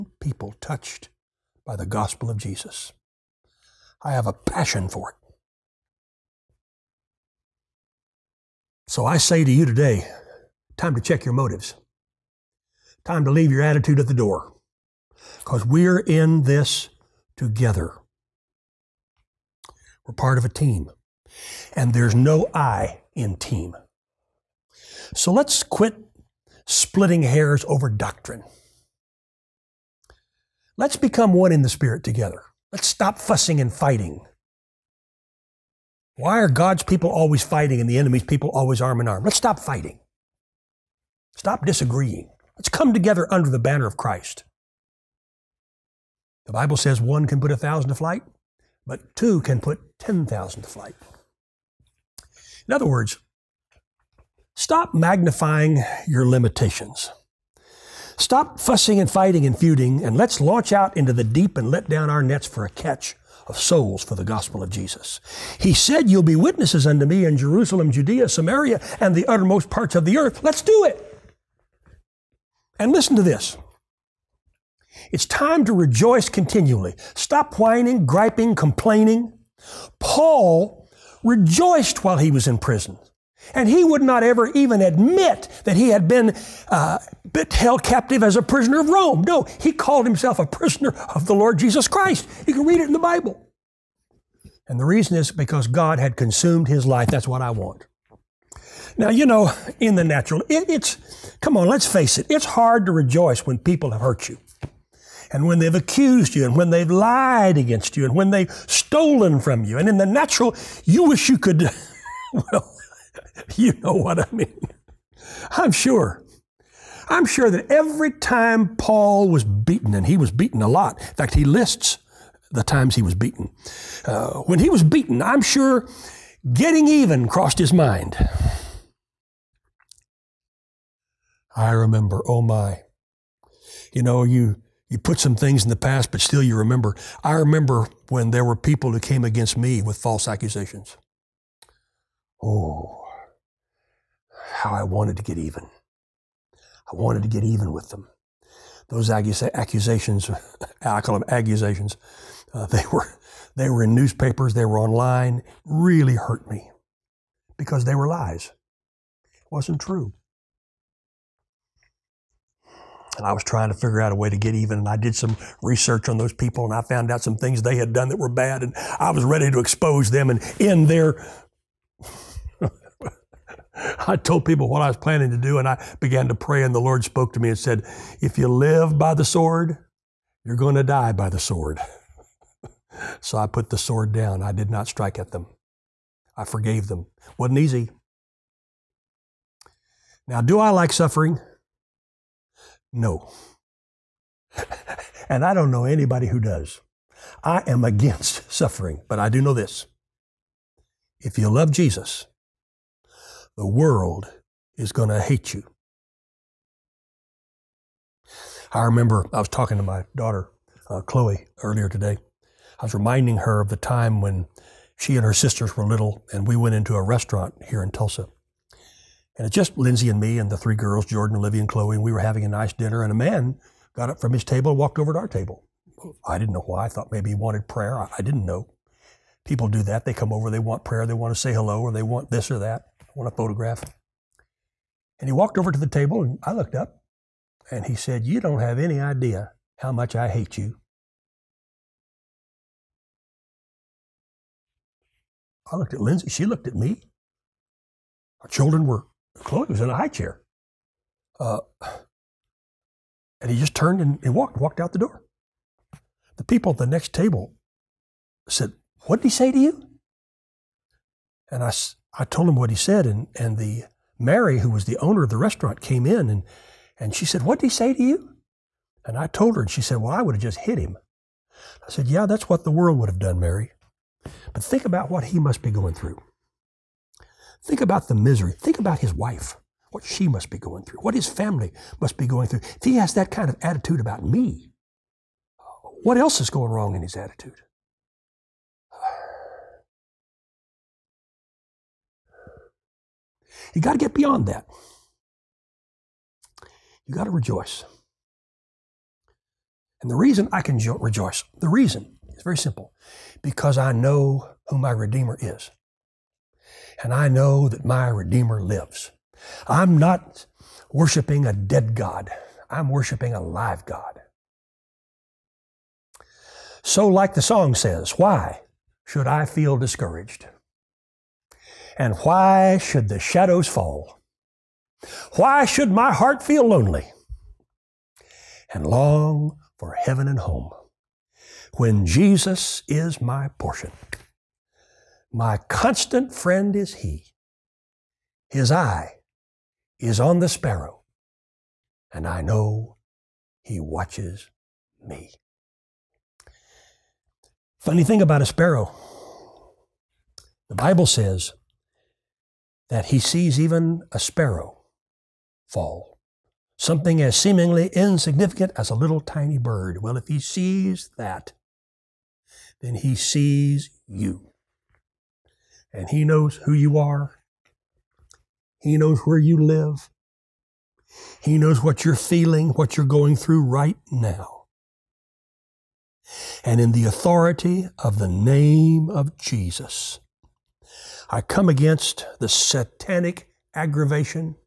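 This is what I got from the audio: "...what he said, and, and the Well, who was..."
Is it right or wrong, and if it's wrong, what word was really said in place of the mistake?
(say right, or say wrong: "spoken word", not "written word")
wrong: "Mary", not "Well".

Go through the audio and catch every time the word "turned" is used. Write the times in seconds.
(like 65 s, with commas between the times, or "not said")
253 s.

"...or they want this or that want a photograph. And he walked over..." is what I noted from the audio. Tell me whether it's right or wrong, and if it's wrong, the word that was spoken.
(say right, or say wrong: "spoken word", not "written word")
right.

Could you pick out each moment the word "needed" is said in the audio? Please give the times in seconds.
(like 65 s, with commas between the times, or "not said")
not said.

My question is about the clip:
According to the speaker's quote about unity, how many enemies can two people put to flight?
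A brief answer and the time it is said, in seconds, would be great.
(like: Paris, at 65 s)
10,000, at 50 s.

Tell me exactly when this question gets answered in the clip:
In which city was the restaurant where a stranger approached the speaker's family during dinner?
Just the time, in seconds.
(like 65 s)
217 s.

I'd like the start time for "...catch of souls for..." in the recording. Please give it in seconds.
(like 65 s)
62 s.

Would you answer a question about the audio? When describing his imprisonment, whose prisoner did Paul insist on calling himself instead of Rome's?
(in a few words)
The Lord Jesus Christ.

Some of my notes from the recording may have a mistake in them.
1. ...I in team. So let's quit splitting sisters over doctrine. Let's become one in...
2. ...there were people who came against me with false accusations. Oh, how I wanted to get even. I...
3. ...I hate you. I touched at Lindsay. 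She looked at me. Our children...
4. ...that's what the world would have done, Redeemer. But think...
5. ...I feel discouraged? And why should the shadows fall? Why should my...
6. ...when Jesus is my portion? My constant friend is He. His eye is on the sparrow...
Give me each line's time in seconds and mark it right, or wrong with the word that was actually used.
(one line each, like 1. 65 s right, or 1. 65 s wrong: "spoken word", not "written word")
1. 22 s wrong: "hairs", not "sisters"
2. 138 s right
3. 240 s wrong: "looked", not "touched"
4. 272 s wrong: "Mary", not "Redeemer"
5. 319 s right
6. 331 s right.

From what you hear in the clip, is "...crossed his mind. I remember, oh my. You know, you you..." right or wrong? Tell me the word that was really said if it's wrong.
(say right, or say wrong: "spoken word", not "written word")
right.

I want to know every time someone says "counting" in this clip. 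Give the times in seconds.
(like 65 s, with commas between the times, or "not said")
not said.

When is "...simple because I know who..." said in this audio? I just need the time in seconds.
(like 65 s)
302 s.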